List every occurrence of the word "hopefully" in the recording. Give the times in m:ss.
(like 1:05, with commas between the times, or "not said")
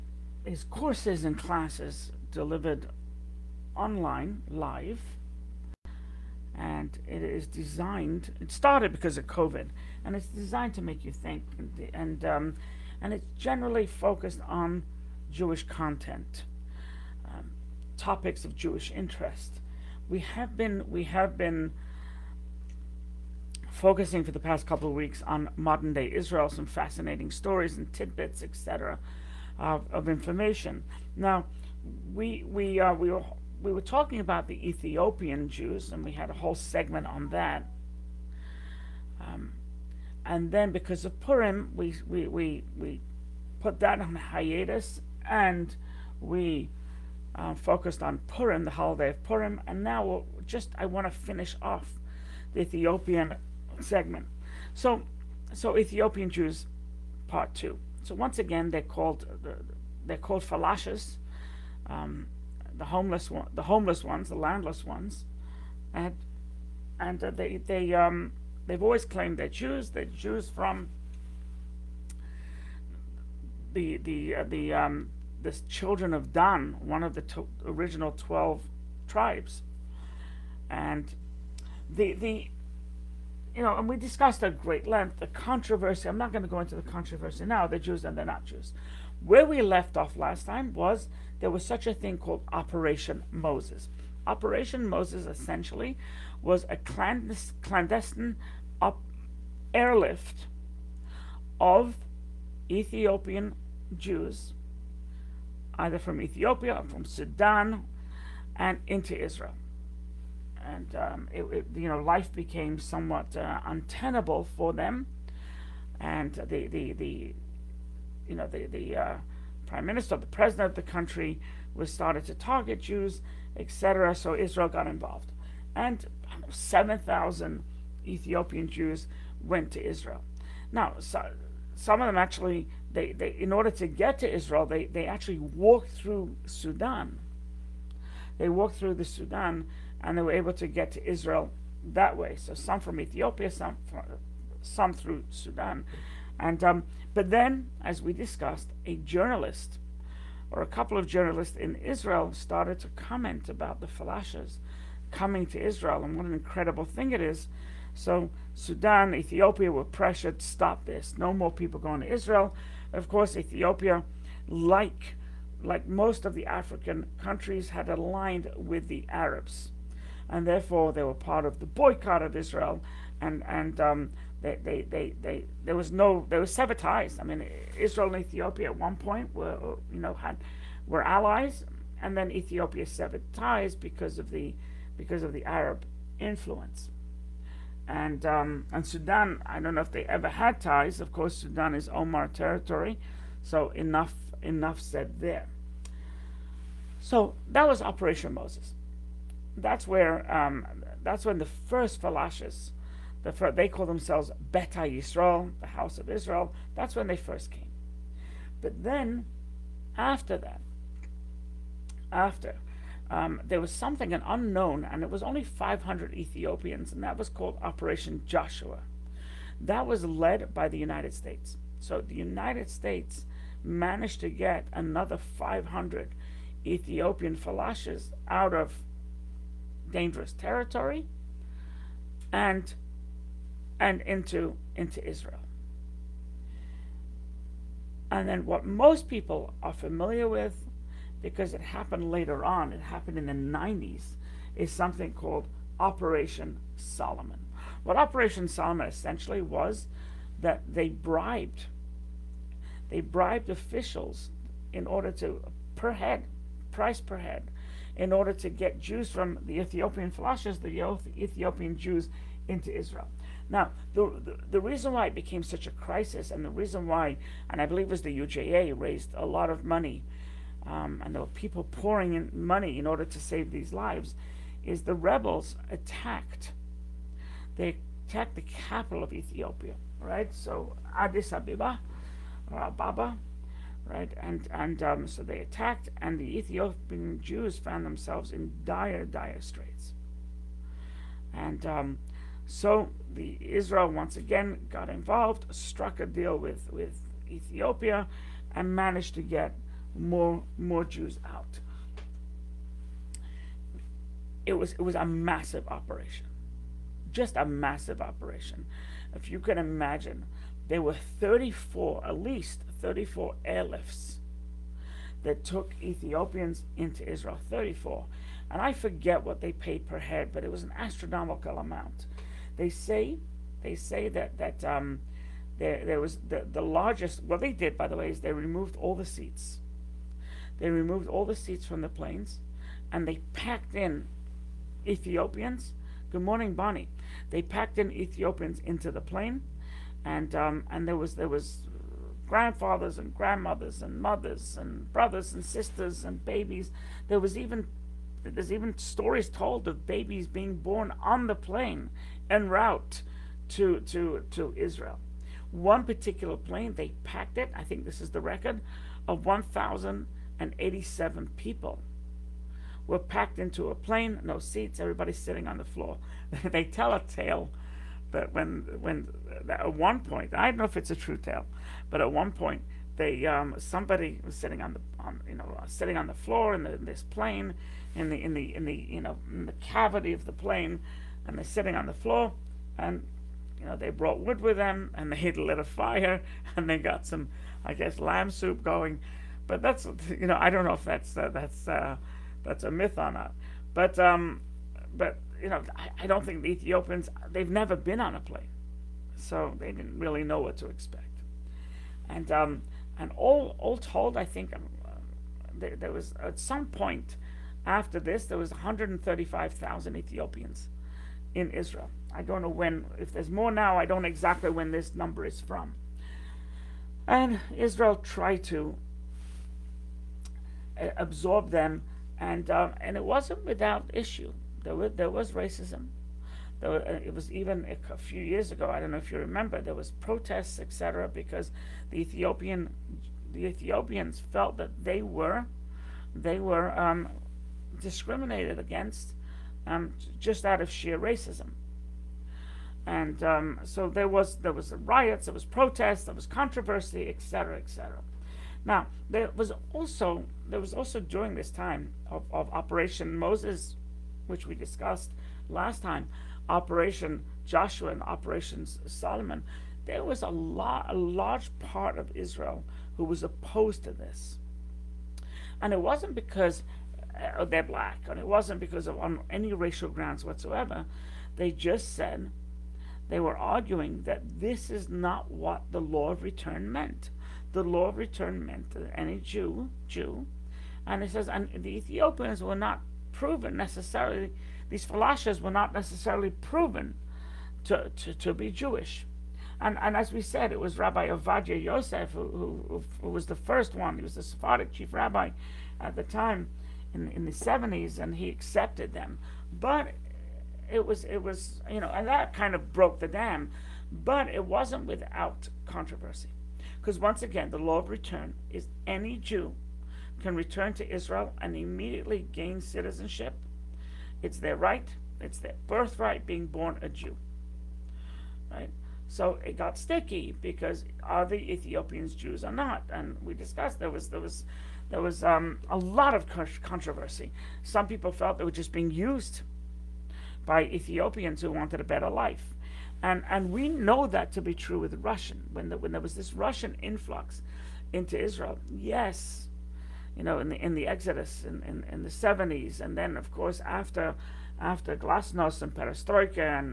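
not said.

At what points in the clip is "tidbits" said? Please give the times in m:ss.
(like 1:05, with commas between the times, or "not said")
0:27.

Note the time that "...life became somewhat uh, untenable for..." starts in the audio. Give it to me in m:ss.
1:52.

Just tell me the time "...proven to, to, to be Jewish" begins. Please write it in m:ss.
8:06.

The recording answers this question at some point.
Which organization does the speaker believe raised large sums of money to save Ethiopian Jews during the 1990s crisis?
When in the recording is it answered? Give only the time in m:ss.
4:28.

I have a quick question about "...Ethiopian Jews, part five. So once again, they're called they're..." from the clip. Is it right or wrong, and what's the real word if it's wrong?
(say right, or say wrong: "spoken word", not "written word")
wrong: "two", not "five".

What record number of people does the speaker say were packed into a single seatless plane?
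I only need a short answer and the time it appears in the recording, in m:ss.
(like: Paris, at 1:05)
1,087, at 5:59.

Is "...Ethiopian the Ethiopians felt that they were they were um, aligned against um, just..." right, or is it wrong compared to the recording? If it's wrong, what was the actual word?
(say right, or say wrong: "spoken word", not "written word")
wrong: "discriminated", not "aligned".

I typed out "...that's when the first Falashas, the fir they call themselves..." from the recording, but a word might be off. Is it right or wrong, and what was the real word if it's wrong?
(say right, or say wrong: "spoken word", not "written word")
right.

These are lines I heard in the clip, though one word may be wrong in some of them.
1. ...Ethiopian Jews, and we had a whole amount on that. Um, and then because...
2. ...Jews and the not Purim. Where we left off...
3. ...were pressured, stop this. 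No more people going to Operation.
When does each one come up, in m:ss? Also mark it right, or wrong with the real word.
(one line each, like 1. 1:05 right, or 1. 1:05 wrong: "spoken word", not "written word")
1. 0:34 wrong: "segment", not "amount"
2. 1:27 wrong: "Jews", not "Purim"
3. 2:39 wrong: "Israel", not "Operation".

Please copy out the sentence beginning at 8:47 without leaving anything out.
Some people felt they were just being used by Ethiopians who wanted a better life.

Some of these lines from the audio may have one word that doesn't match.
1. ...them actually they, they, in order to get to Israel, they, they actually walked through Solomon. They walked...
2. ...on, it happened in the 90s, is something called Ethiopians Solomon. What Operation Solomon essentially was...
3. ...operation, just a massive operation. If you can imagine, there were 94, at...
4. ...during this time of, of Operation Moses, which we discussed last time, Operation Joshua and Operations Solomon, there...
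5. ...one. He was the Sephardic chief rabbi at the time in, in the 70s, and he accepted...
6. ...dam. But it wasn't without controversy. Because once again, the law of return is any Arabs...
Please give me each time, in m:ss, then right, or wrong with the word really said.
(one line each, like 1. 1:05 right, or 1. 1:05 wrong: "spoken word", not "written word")
1. 2:12 wrong: "Sudan", not "Solomon"
2. 4:02 wrong: "Operation", not "Ethiopians"
3. 5:05 wrong: "34", not "94"
4. 7:31 right
5. 8:13 right
6. 8:23 wrong: "Jew", not "Arabs".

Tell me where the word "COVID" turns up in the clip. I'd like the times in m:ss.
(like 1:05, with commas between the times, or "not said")
0:09.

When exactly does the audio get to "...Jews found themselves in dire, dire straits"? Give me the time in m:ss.
4:47.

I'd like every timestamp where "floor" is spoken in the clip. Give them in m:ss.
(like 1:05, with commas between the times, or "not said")
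6:05, 6:16, 6:21.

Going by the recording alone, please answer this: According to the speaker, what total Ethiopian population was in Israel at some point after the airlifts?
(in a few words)
135,000.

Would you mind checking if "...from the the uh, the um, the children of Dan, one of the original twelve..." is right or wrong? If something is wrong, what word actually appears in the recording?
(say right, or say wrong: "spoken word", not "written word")
right.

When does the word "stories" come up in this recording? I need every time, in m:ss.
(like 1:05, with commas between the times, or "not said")
0:27, 5:48.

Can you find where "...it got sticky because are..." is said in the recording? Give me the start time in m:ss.
8:39.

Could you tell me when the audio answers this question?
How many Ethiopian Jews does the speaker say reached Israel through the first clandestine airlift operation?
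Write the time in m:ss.
2:06.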